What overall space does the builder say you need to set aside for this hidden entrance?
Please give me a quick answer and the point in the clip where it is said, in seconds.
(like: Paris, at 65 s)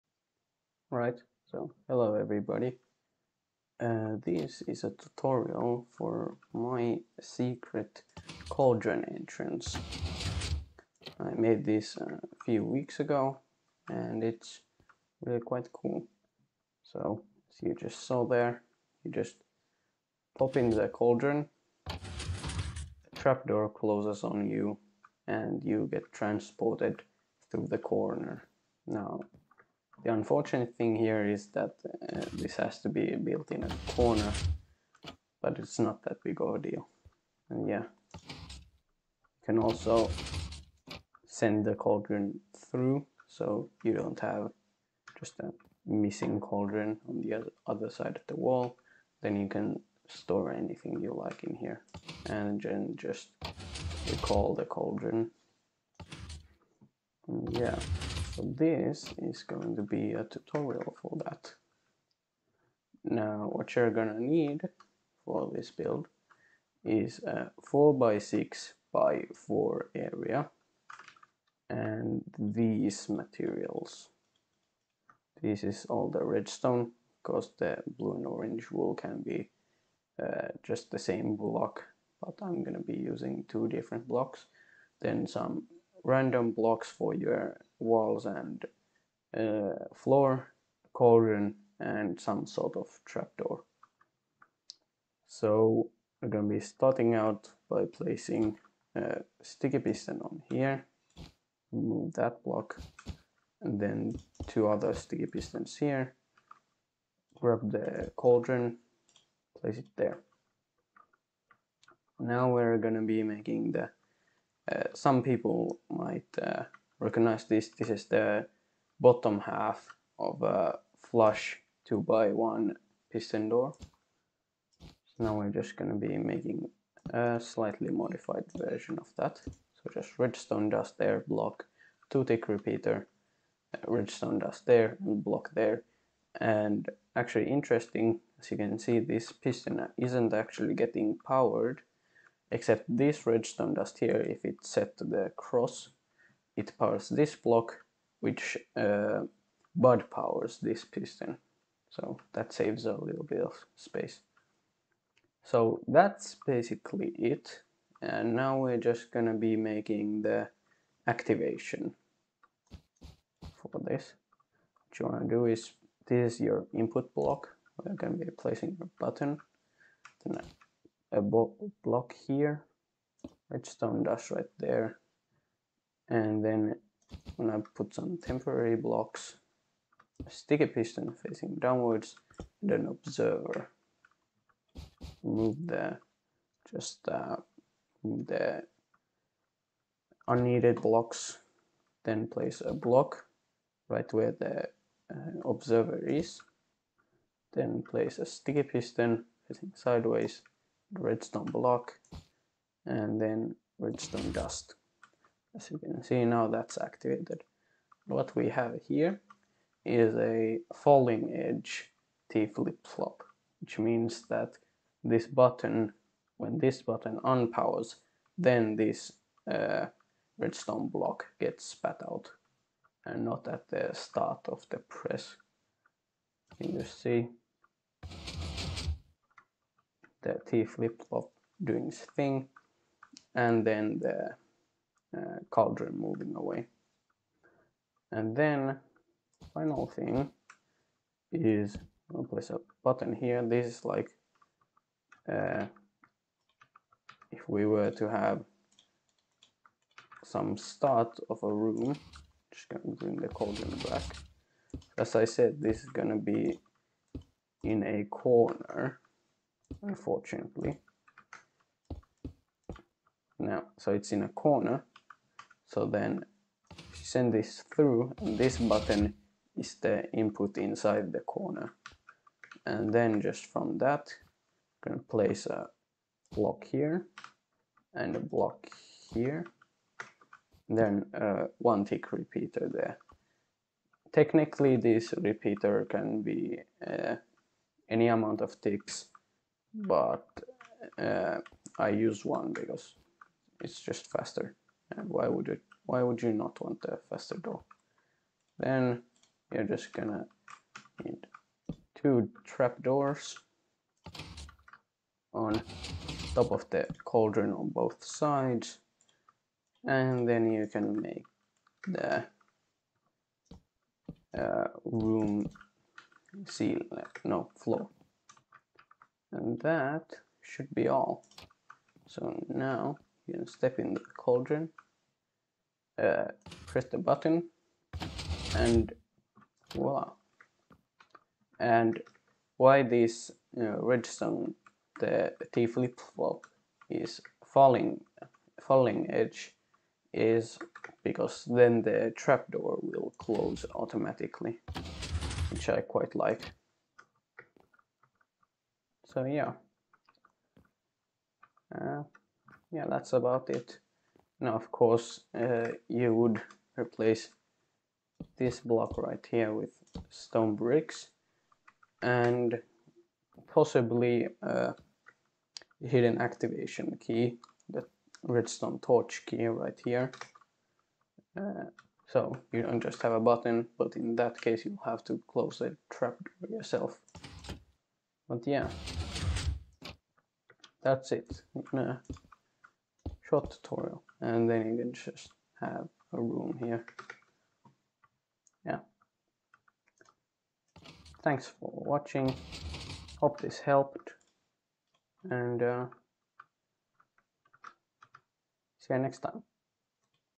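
4x6 by 4, at 67 s.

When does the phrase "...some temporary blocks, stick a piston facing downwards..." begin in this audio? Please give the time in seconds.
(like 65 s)
177 s.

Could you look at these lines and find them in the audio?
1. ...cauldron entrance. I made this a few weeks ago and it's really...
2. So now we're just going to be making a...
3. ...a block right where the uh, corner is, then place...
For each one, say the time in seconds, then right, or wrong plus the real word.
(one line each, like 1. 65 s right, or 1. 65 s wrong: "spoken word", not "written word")
1. 8 s right
2. 124 s right
3. 192 s wrong: "observer", not "corner".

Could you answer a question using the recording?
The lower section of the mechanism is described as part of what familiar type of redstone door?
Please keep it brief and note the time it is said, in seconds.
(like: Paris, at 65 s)
flush 2 by one piston door, at 121 s.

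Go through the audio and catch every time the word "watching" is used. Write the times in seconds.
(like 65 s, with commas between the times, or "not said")
391 s.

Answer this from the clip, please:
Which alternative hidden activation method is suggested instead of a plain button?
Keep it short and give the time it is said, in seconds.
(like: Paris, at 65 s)
redstone torch key, at 368 s.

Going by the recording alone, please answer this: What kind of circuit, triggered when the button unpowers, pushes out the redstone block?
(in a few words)
falling edge T flip-flop.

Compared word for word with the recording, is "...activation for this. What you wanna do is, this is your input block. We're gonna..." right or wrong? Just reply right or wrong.
right.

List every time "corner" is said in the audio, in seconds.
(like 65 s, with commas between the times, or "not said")
27 s, 33 s, 258 s, 264 s, 271 s.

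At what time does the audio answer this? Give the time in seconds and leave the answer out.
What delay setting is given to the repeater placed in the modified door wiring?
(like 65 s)
132 s.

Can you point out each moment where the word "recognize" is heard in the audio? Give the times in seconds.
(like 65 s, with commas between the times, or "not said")
116 s.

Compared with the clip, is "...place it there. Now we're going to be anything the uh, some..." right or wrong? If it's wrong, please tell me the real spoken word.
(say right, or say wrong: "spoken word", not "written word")
wrong: "making", not "anything".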